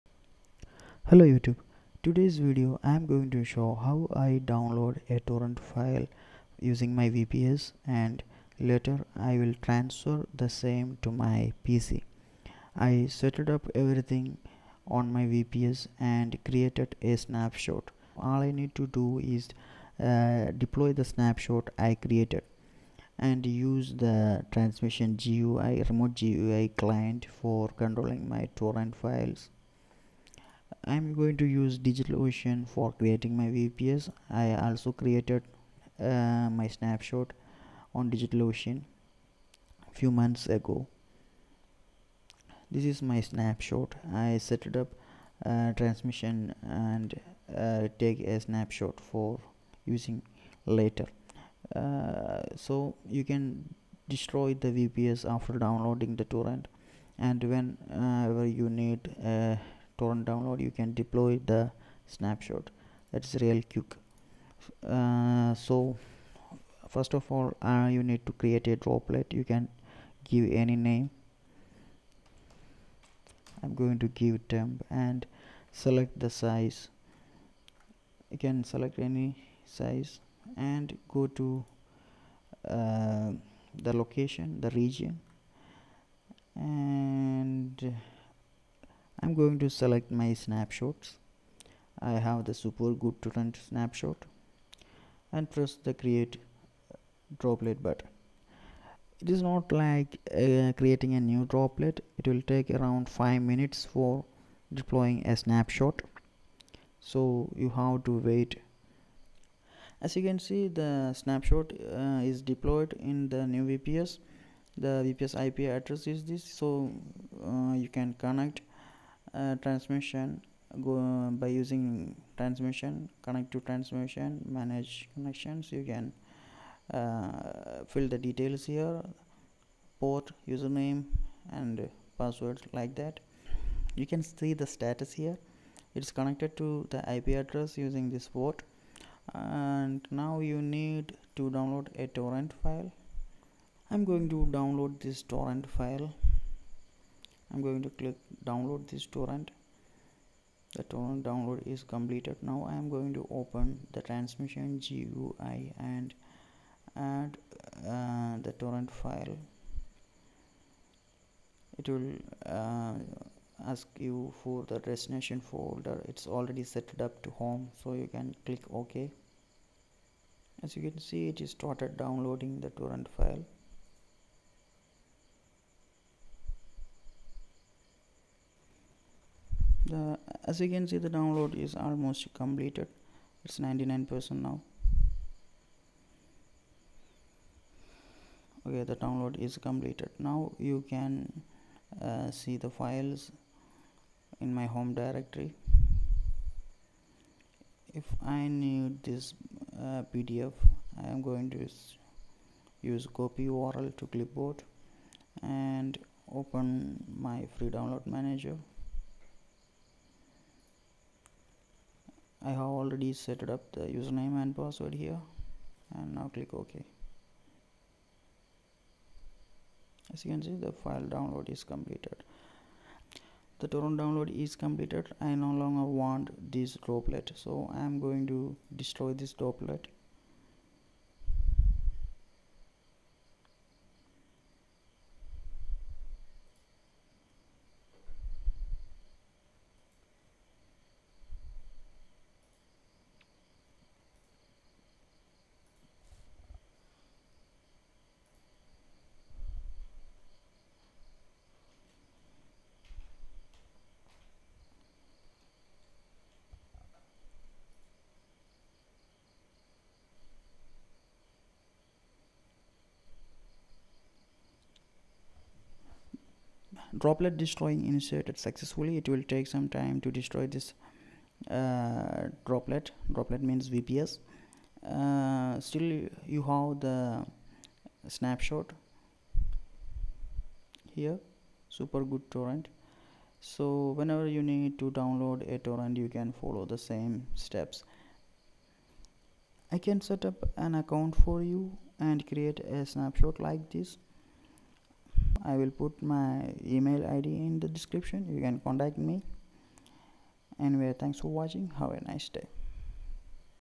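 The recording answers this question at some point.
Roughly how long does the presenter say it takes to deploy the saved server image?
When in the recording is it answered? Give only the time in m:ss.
1:43.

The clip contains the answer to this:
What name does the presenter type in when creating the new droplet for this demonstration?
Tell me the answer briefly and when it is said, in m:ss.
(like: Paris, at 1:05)
temp, at 1:14.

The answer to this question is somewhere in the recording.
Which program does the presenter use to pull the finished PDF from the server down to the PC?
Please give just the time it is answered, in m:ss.
3:27.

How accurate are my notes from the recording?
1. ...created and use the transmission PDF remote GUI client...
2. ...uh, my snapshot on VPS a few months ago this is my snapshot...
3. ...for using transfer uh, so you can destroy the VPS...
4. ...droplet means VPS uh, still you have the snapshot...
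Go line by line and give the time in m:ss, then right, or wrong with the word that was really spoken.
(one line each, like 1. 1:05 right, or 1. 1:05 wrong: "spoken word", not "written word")
1. 0:21 wrong: "GUI", not "PDF"
2. 0:35 wrong: "DigitalOcean", not "VPS"
3. 0:48 wrong: "later", not "transfer"
4. 4:33 right.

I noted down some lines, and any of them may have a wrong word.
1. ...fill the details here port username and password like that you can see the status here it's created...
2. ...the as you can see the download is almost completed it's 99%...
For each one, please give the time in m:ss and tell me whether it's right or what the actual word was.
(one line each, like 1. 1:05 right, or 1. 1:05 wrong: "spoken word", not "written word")
1. 2:07 wrong: "connected", not "created"
2. 2:59 right.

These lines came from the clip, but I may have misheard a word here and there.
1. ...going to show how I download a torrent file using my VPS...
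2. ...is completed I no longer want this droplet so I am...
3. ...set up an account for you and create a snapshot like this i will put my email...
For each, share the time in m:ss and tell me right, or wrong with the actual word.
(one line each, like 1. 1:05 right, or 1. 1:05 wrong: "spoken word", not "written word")
1. 0:03 right
2. 3:44 right
3. 4:50 right.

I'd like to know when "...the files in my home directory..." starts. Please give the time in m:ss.
3:12.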